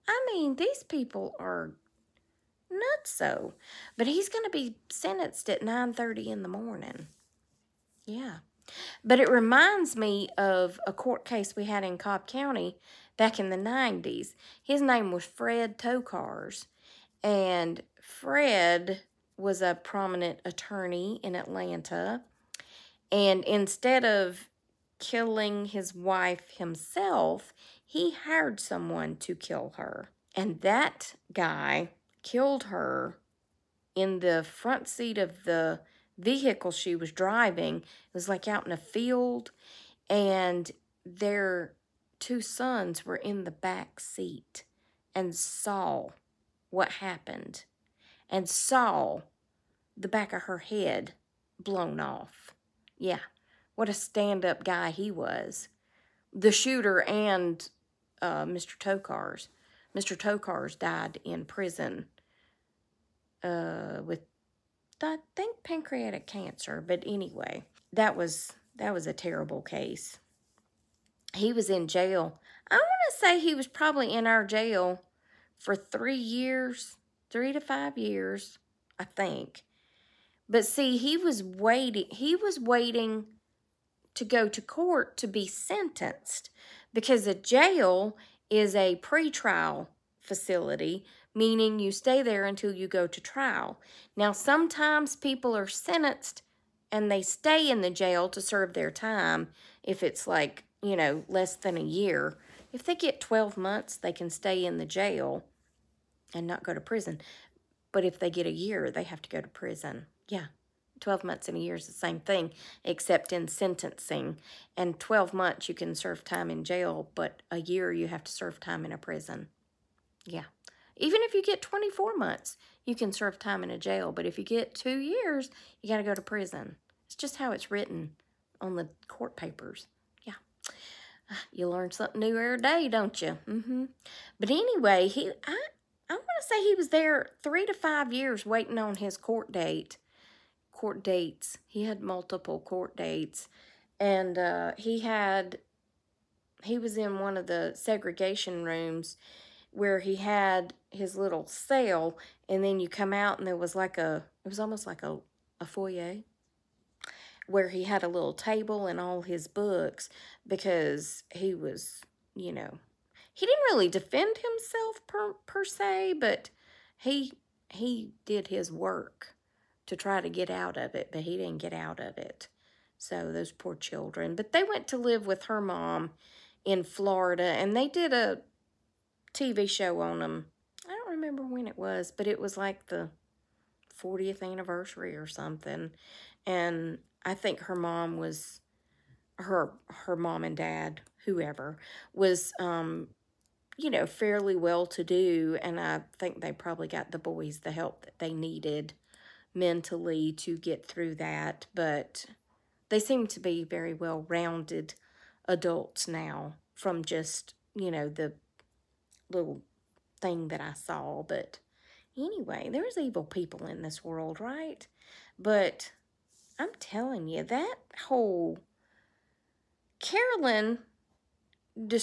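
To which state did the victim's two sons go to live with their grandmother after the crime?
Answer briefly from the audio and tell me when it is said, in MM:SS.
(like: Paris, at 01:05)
Florida, at 02:56.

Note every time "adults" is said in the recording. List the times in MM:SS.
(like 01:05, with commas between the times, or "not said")
03:25.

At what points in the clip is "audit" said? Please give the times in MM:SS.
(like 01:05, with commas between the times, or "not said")
not said.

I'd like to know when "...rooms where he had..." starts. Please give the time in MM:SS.
02:28.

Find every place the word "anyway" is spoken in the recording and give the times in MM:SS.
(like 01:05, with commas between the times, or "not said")
01:07, 02:14, 03:32.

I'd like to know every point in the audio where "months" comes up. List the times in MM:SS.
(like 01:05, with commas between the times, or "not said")
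01:43, 01:51, 01:55, 02:02.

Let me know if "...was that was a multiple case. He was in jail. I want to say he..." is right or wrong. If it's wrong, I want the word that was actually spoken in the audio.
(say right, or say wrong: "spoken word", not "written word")
wrong: "terrible", not "multiple".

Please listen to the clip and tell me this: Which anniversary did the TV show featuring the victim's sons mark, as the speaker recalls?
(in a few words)
40th.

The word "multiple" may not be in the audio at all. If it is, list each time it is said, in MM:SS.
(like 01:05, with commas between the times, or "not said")
02:22.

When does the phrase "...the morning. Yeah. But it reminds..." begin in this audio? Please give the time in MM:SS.
00:06.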